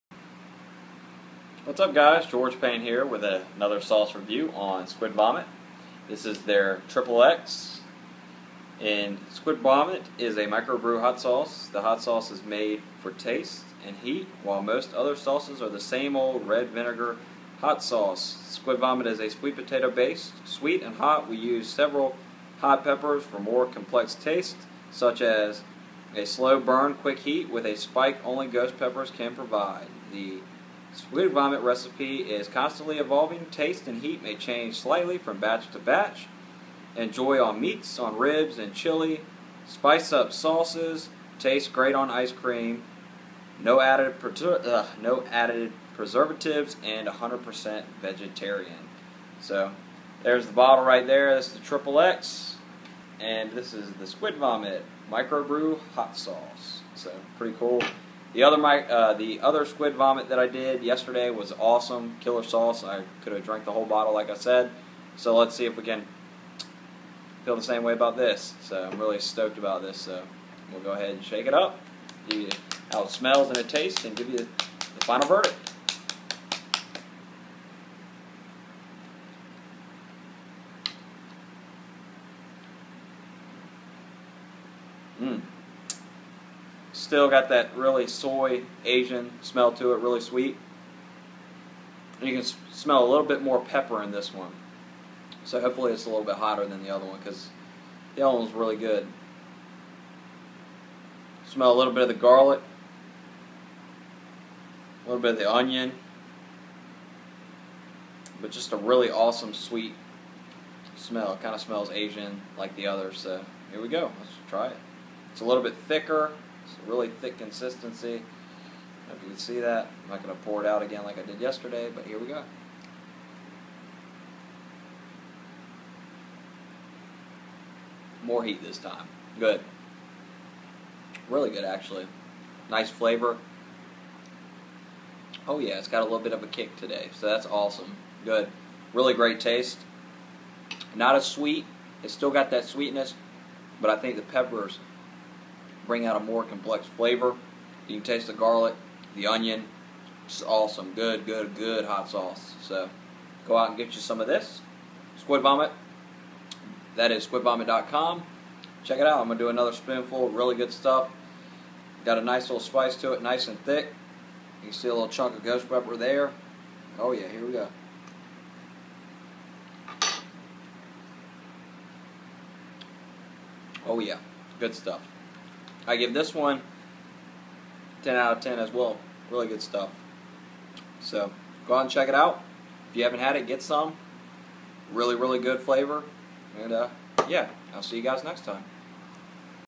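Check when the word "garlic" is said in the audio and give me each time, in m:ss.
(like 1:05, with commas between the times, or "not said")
1:42, 2:28.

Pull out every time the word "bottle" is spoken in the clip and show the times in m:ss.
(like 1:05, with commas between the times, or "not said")
0:50, 1:03.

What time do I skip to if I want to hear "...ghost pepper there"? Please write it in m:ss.
2:45.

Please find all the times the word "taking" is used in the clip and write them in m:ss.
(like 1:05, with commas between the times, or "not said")
not said.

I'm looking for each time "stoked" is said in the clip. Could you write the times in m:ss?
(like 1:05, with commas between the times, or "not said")
1:09.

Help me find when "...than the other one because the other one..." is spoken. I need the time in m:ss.
1:36.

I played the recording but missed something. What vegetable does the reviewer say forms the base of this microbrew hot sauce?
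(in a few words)
Sweet potato.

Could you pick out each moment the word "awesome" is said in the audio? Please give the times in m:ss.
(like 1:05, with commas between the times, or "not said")
1:01, 1:49, 2:17, 2:30.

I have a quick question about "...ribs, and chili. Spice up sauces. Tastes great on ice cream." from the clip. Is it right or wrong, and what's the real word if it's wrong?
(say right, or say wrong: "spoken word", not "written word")
right.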